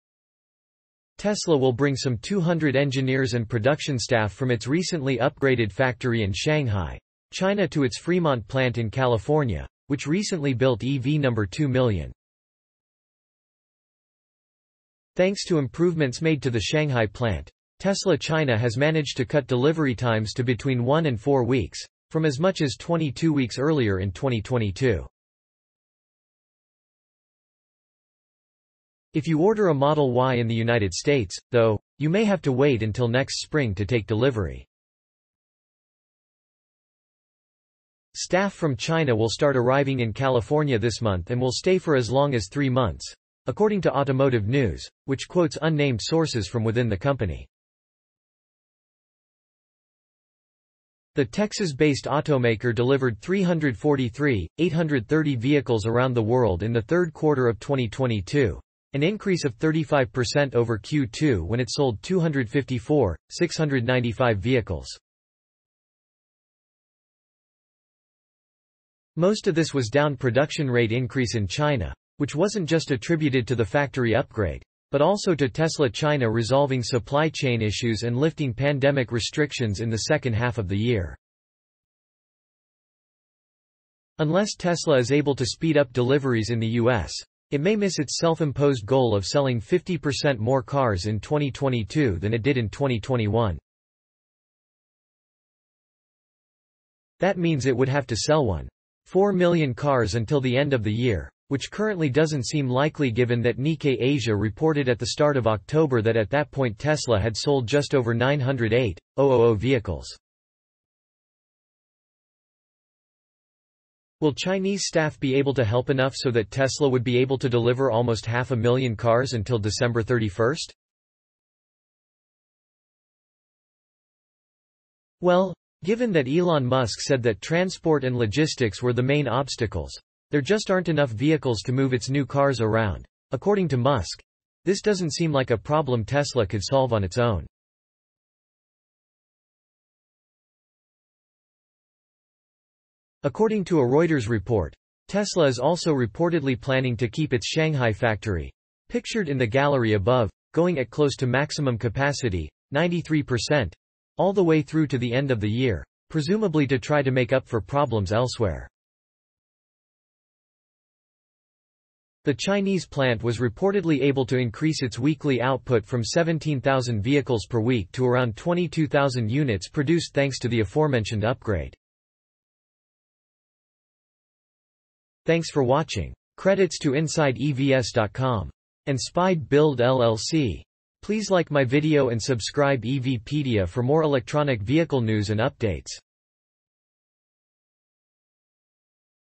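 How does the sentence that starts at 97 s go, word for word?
That means it would have to sell one.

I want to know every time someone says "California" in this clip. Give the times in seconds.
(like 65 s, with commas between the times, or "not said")
8 s, 40 s.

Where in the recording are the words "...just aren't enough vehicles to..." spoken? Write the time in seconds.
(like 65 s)
130 s.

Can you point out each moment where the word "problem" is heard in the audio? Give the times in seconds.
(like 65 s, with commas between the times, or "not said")
135 s, 157 s.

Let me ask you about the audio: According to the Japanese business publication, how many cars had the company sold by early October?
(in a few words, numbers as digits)
just over 908,000.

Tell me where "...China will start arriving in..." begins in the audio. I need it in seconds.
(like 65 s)
38 s.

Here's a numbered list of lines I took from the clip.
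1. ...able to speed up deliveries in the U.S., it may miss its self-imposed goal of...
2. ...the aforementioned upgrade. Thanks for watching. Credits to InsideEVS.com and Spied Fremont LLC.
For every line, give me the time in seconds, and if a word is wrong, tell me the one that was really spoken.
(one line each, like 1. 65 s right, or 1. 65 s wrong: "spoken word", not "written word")
1. 85 s right
2. 170 s wrong: "Build", not "Fremont".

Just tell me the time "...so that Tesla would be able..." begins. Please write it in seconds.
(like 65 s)
116 s.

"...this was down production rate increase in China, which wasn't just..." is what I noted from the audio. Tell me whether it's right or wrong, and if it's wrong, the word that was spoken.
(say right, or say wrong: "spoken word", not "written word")
right.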